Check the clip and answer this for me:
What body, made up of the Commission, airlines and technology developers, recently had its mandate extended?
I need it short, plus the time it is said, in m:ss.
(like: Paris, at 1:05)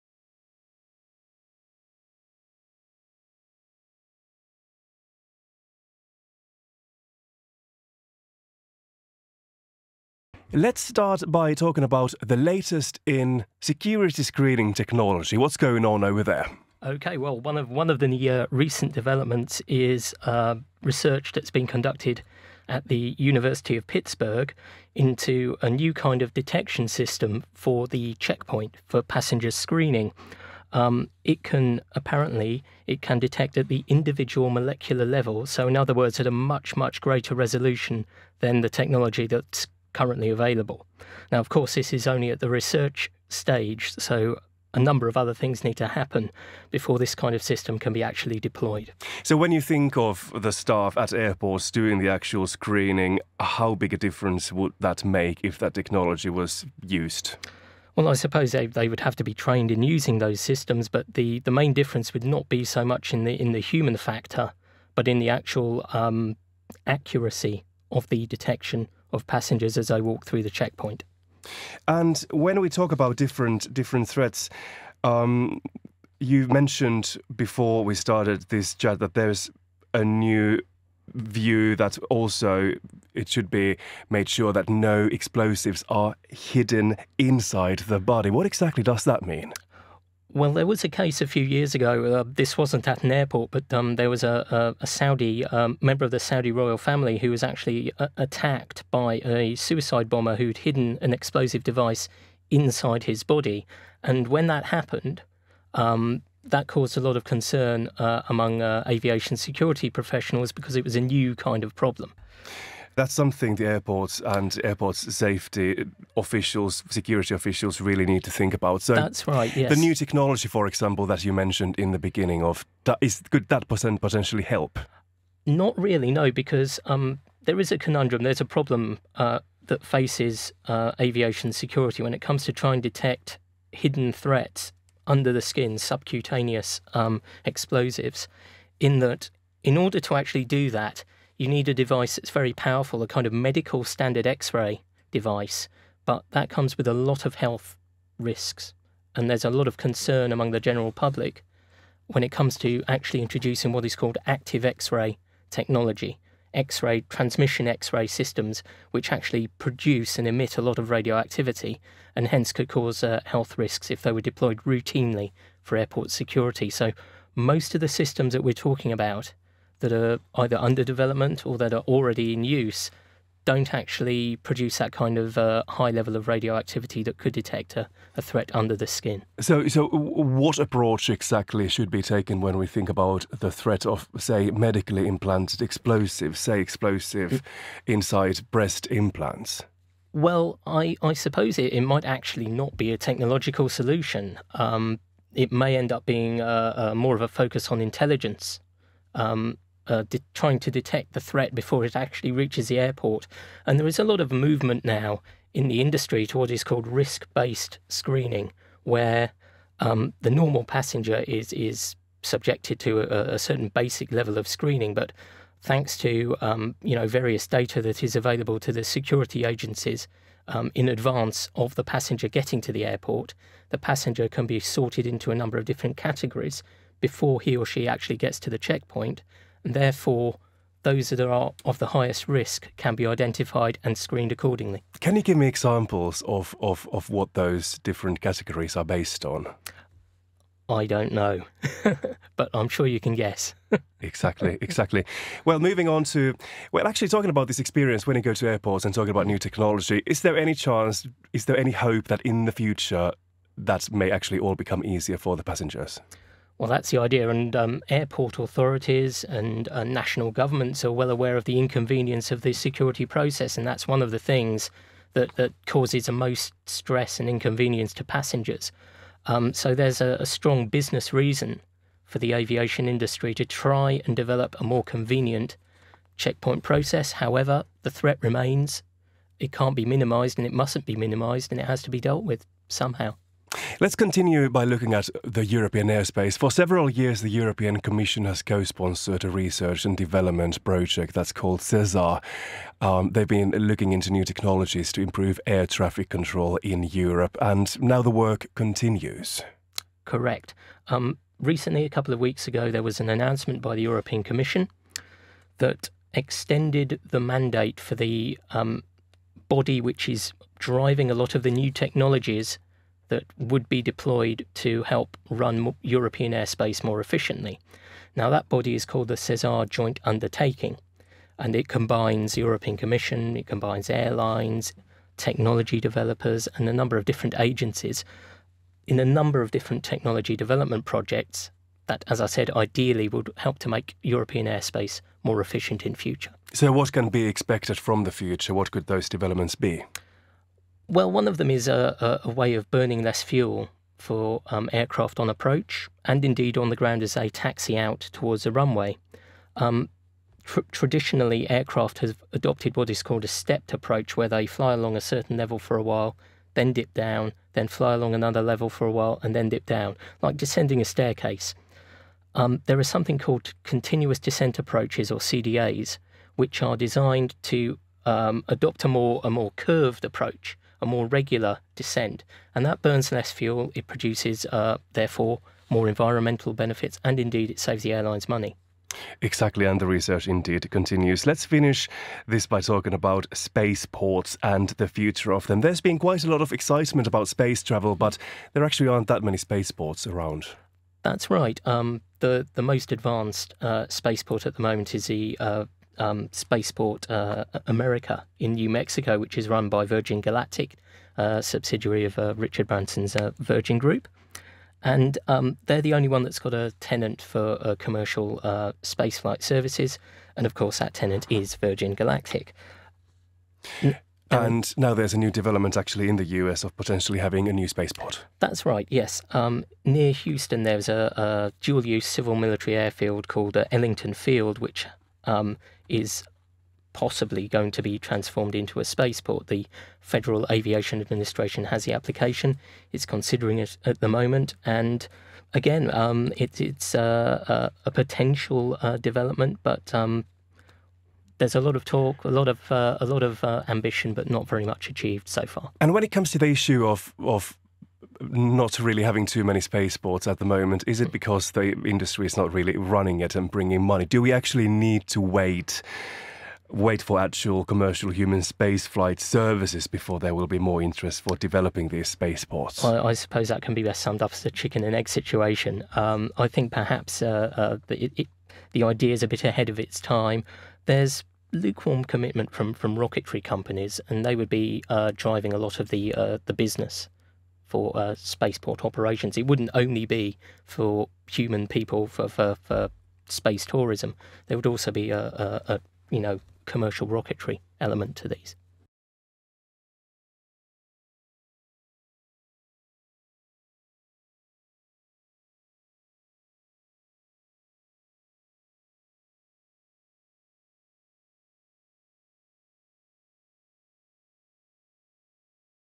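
SESAR Joint Undertaking, at 5:19.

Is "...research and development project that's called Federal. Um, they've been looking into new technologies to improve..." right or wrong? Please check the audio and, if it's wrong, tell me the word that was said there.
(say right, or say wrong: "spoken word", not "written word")
wrong: "SESAR", not "Federal".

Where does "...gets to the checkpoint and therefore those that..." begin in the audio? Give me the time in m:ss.
3:48.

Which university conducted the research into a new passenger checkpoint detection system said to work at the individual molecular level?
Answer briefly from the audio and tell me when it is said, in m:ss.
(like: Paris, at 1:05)
University of Pittsburgh, at 0:23.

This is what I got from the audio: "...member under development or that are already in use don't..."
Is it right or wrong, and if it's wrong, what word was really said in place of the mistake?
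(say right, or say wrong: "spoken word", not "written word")
wrong: "either", not "member".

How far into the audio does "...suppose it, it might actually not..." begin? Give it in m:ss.
3:11.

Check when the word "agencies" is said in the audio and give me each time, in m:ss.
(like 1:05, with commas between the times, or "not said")
3:39, 5:27.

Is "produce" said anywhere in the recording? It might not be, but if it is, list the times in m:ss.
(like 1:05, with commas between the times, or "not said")
2:39, 2:54, 6:13.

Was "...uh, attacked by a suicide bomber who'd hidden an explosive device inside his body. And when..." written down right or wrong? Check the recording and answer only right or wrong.
right.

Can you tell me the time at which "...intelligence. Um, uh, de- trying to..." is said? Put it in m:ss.
3:17.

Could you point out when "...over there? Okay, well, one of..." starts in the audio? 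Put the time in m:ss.
0:16.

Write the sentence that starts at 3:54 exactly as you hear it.
Can you give me examples of, of, of what those different categories are based on?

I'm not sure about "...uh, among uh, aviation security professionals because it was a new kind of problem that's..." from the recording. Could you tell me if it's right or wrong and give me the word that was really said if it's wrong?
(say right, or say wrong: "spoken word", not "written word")
right.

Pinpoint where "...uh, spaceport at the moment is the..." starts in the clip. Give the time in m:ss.
6:33.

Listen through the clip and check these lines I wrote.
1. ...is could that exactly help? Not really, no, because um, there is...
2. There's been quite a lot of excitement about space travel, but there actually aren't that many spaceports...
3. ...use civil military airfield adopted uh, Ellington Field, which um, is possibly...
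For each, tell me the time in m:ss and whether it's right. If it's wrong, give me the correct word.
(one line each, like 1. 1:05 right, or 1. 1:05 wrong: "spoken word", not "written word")
1. 2:03 wrong: "potentially", not "exactly"
2. 6:25 right
3. 7:01 wrong: "called", not "adopted".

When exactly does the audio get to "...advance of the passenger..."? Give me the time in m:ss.
3:40.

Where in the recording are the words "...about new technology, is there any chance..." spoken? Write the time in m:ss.
4:09.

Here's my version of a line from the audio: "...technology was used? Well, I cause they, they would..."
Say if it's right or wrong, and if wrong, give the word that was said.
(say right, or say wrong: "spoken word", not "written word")
wrong: "suppose", not "cause".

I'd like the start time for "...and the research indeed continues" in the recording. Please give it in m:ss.
6:19.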